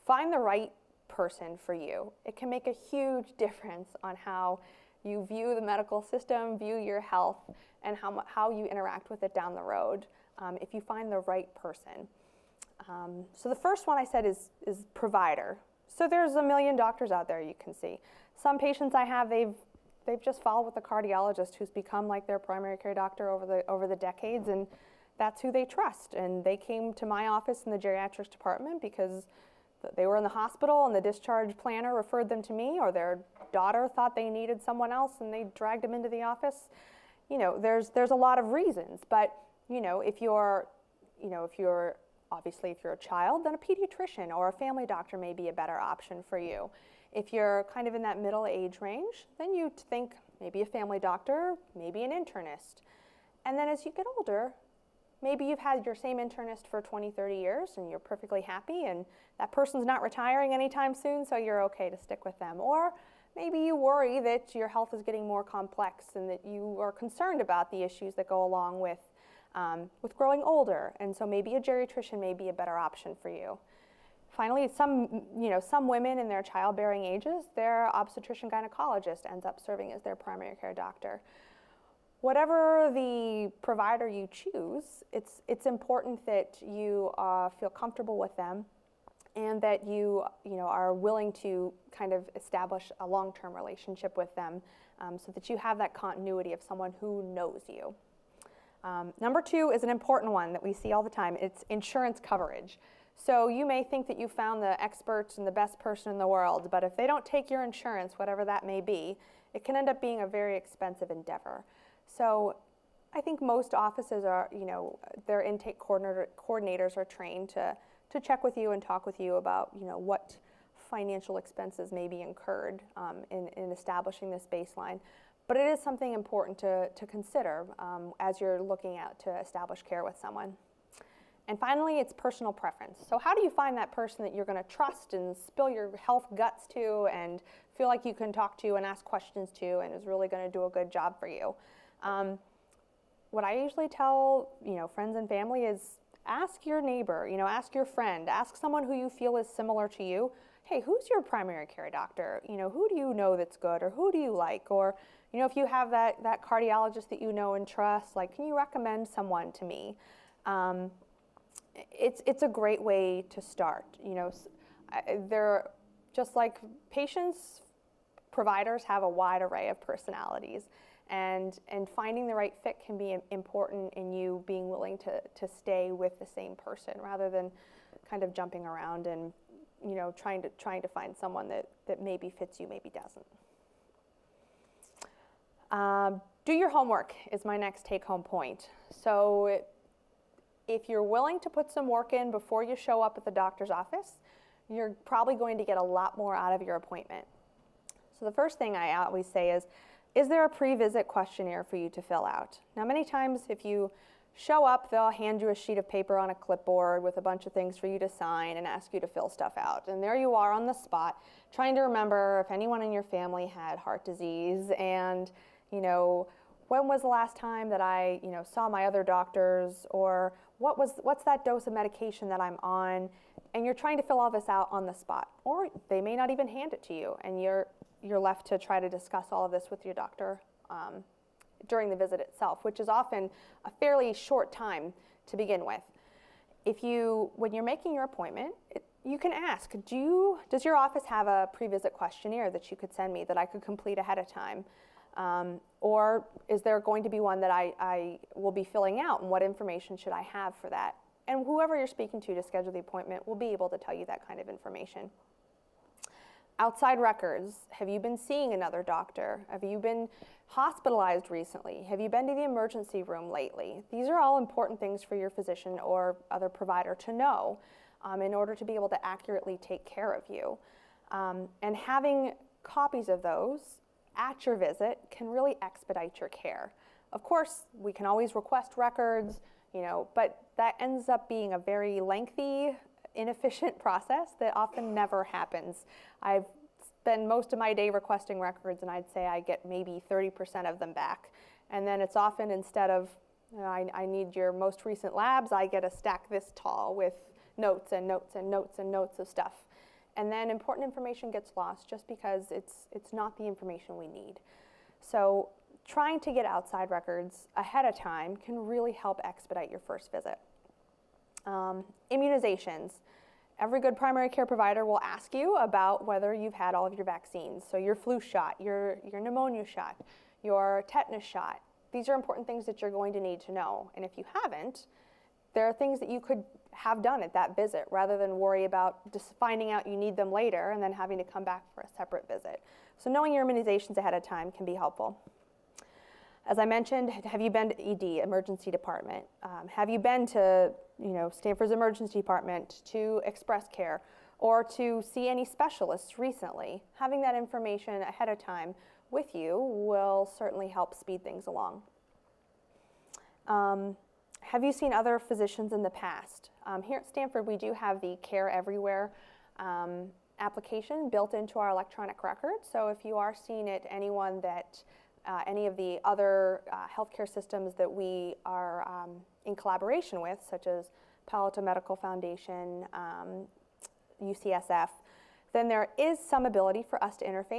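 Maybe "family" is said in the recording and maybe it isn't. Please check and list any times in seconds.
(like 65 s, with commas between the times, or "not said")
44 s, 50 s, 145 s, 213 s.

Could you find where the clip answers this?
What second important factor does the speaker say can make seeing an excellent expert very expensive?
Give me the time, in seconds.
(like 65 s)
101 s.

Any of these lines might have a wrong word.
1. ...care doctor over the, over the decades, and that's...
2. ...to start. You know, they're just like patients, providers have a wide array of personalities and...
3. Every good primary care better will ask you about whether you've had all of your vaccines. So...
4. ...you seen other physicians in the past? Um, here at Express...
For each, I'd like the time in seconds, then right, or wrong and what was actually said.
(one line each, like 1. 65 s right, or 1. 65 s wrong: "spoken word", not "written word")
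1. 22 s right
2. 163 s right
3. 313 s wrong: "provider", not "better"
4. 354 s wrong: "Stanford", not "Express".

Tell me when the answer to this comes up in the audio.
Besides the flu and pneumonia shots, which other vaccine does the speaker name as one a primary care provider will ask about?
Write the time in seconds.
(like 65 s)
320 s.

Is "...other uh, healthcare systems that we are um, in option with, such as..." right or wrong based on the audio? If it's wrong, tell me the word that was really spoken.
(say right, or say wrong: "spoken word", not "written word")
wrong: "collaboration", not "option".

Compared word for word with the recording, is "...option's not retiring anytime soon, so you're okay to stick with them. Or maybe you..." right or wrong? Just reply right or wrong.
wrong.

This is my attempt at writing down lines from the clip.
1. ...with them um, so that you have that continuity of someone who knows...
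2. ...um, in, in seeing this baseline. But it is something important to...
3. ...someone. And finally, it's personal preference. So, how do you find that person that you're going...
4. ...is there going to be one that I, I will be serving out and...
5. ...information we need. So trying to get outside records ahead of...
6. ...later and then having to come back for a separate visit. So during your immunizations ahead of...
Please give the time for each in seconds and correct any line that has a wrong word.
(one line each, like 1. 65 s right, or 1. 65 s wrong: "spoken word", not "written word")
1. 94 s right
2. 122 s wrong: "establishing", not "seeing"
3. 130 s right
4. 246 s wrong: "filling", not "serving"
5. 303 s right
6. 330 s wrong: "knowing", not "during".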